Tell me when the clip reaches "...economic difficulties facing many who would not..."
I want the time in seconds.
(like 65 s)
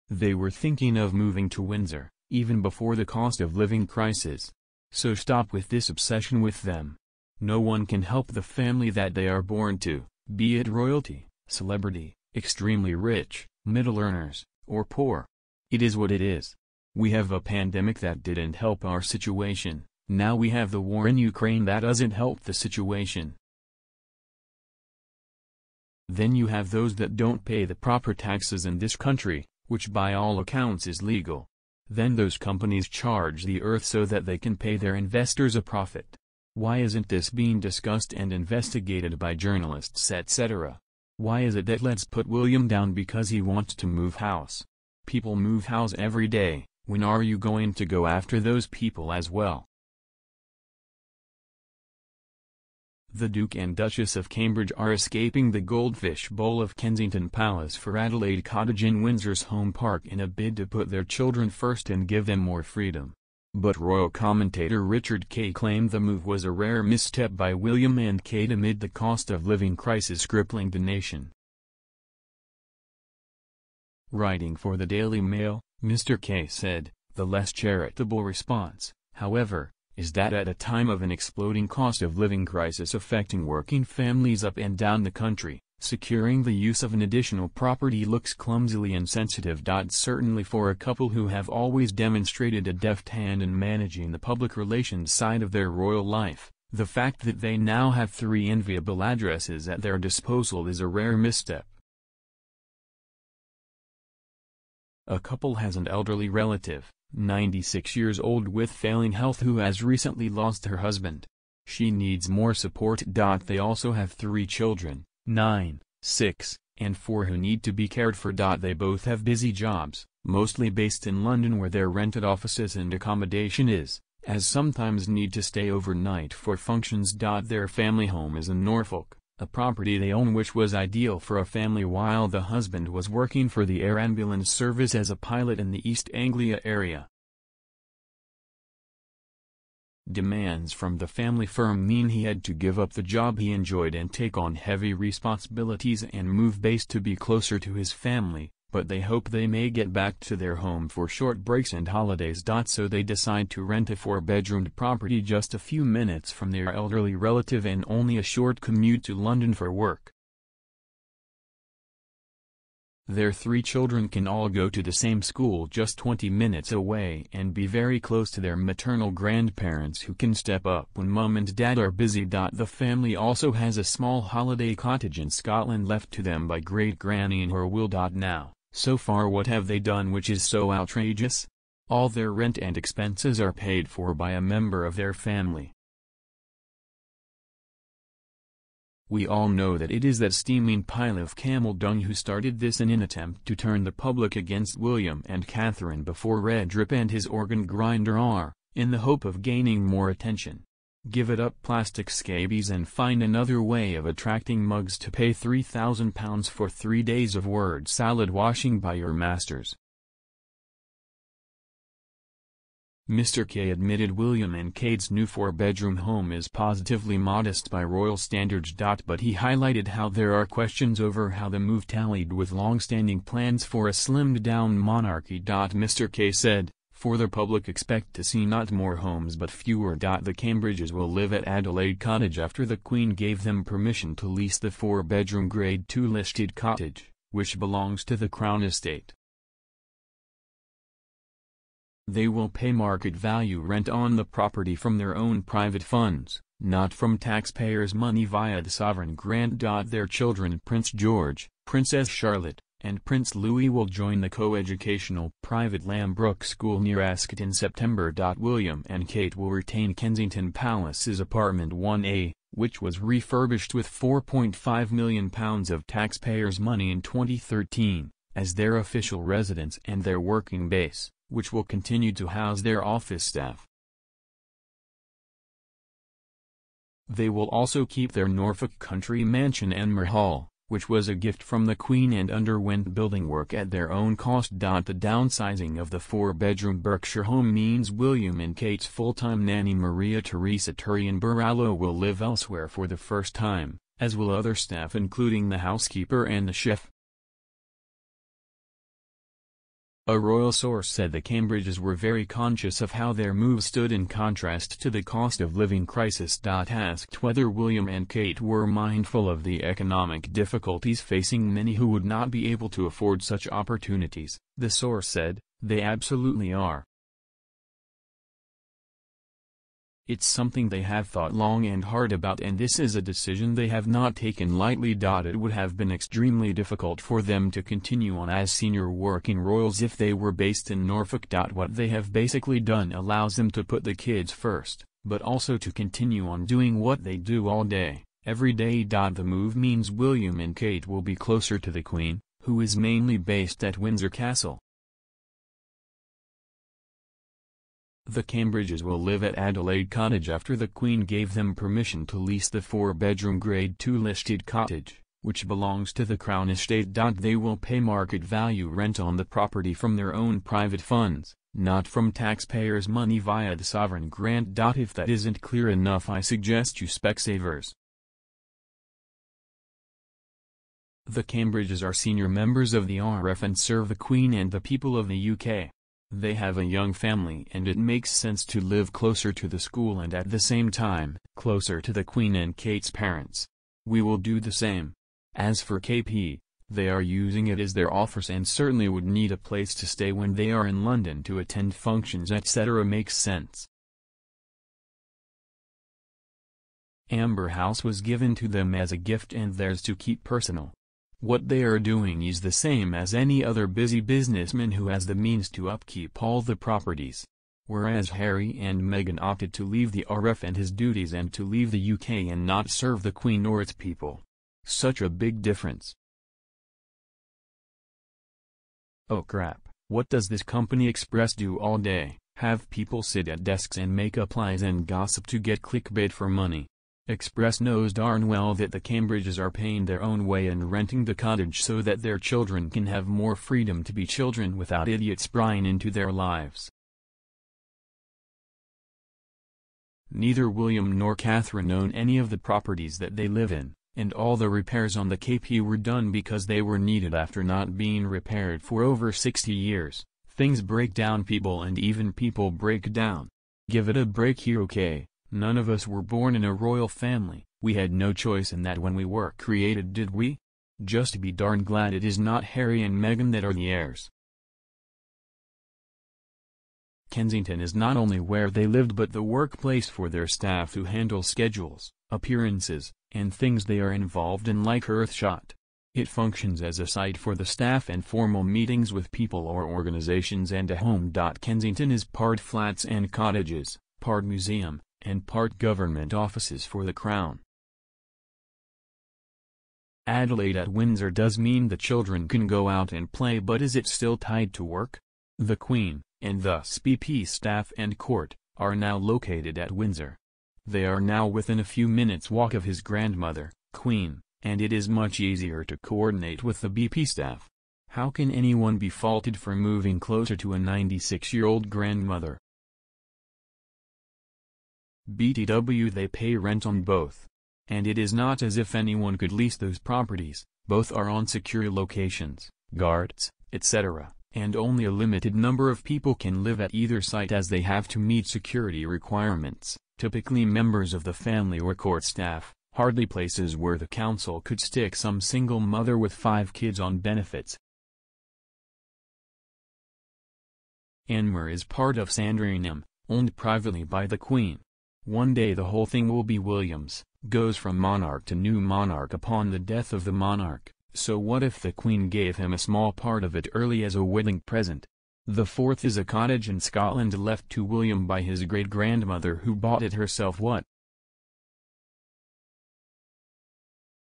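309 s.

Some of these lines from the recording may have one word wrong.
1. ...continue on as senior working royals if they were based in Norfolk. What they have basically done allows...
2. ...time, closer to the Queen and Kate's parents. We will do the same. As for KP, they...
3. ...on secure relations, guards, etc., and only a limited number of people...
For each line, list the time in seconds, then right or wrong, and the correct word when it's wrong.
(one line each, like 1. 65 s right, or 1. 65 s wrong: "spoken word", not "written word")
1. 327 s right
2. 380 s right
3. 521 s wrong: "locations", not "relations".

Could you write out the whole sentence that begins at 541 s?
Anmer is part of Sandringham, owned privately by the Queen.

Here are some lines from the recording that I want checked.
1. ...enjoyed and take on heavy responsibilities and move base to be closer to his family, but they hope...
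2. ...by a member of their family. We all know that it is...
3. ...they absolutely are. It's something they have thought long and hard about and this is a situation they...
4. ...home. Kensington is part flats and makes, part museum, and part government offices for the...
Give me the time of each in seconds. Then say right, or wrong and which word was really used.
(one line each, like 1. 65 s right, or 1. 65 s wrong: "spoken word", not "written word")
1. 143 s right
2. 184 s right
3. 315 s wrong: "decision", not "situation"
4. 480 s wrong: "cottages", not "makes".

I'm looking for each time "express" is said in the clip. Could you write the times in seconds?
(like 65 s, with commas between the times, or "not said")
420 s, 427 s.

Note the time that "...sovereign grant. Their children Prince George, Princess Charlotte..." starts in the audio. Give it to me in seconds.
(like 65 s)
248 s.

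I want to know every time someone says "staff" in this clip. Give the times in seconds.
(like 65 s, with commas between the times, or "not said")
273 s, 294 s, 470 s, 477 s, 497 s, 507 s, 532 s.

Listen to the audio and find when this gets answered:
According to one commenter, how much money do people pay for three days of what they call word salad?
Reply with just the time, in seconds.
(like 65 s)
205 s.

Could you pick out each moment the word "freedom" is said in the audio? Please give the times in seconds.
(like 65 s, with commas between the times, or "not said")
62 s, 433 s.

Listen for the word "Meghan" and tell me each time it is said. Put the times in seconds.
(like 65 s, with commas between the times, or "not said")
408 s, 463 s.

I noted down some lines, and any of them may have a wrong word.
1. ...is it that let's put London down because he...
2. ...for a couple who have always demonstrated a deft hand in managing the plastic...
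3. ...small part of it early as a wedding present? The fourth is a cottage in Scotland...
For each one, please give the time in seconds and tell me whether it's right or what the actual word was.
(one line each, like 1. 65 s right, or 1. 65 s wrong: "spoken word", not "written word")
1. 41 s wrong: "William", not "London"
2. 90 s wrong: "public", not "plastic"
3. 552 s right.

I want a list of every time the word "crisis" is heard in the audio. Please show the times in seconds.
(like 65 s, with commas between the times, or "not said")
3 s, 69 s, 82 s, 305 s.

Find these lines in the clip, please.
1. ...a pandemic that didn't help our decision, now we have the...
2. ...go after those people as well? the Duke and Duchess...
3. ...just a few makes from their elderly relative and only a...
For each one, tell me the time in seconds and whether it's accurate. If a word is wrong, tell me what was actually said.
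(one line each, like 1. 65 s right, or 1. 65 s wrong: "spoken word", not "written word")
1. 17 s wrong: "situation", not "decision"
2. 47 s right
3. 155 s wrong: "minutes", not "makes".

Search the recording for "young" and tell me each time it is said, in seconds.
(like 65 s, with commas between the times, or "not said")
376 s.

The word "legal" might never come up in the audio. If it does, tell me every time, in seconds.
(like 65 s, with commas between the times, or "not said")
31 s.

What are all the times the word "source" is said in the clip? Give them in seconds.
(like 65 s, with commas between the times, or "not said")
300 s, 314 s.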